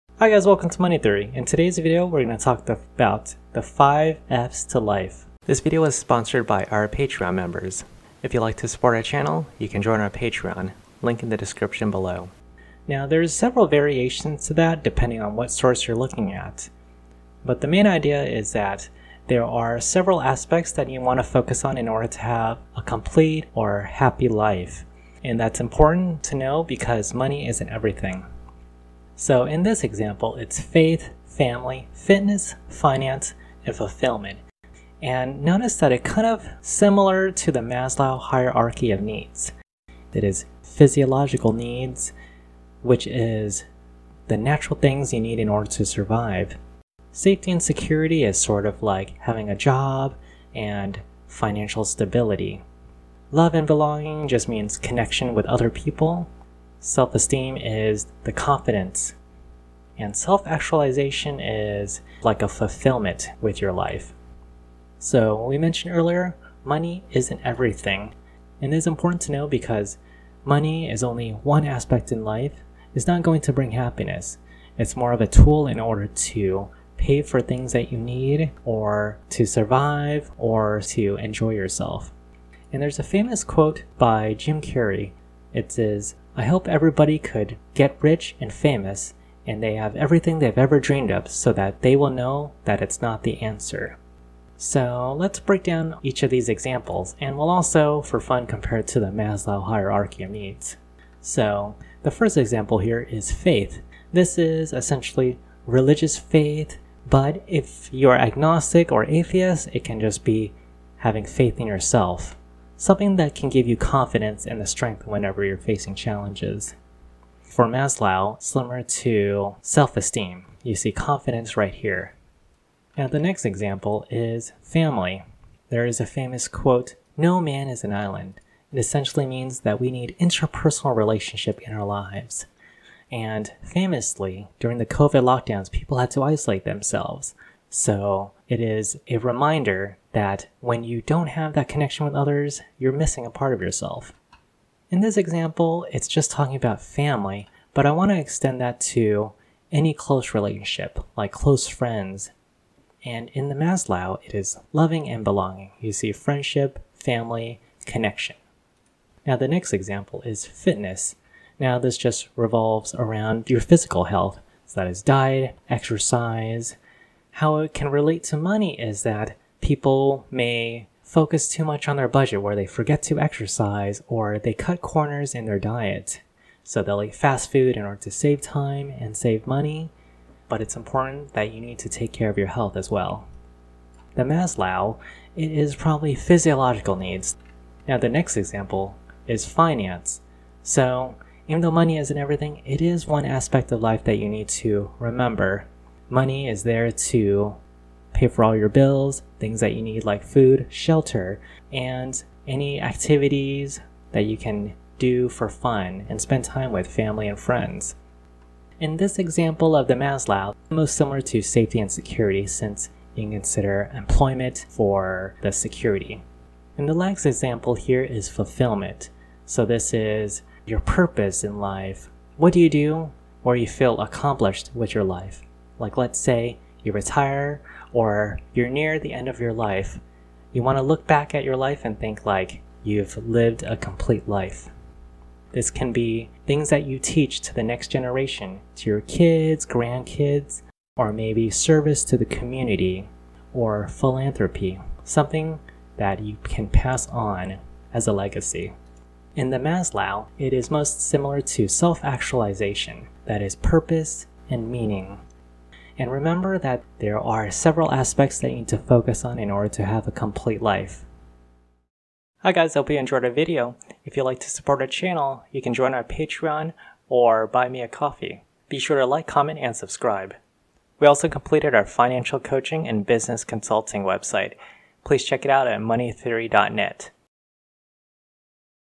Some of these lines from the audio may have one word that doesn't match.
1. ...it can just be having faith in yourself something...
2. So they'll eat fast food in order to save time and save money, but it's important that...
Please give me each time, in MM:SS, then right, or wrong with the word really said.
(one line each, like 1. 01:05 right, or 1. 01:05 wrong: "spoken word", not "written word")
1. 01:49 right
2. 02:56 right.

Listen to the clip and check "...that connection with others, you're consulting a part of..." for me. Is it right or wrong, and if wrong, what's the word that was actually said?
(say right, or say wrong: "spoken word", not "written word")
wrong: "missing", not "consulting".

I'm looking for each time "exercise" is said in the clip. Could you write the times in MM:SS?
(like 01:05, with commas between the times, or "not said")
02:45, 02:53.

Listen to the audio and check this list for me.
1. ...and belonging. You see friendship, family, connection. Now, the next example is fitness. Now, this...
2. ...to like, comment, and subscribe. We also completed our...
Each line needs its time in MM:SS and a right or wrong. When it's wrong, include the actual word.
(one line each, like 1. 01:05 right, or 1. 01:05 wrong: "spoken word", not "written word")
1. 02:35 right
2. 04:28 right.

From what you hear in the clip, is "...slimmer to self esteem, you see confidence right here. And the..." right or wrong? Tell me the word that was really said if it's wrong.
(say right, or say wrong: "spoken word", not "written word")
right.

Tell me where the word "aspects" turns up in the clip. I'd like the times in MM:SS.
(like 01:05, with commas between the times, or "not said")
00:20, 01:11, 03:13, 04:17.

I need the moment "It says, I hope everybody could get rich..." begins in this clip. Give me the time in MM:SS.
01:25.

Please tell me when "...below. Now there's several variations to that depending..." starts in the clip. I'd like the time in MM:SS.
00:11.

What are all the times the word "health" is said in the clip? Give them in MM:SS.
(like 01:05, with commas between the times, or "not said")
02:44, 03:02.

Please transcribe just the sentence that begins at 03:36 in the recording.
And the last example here is fulfillment.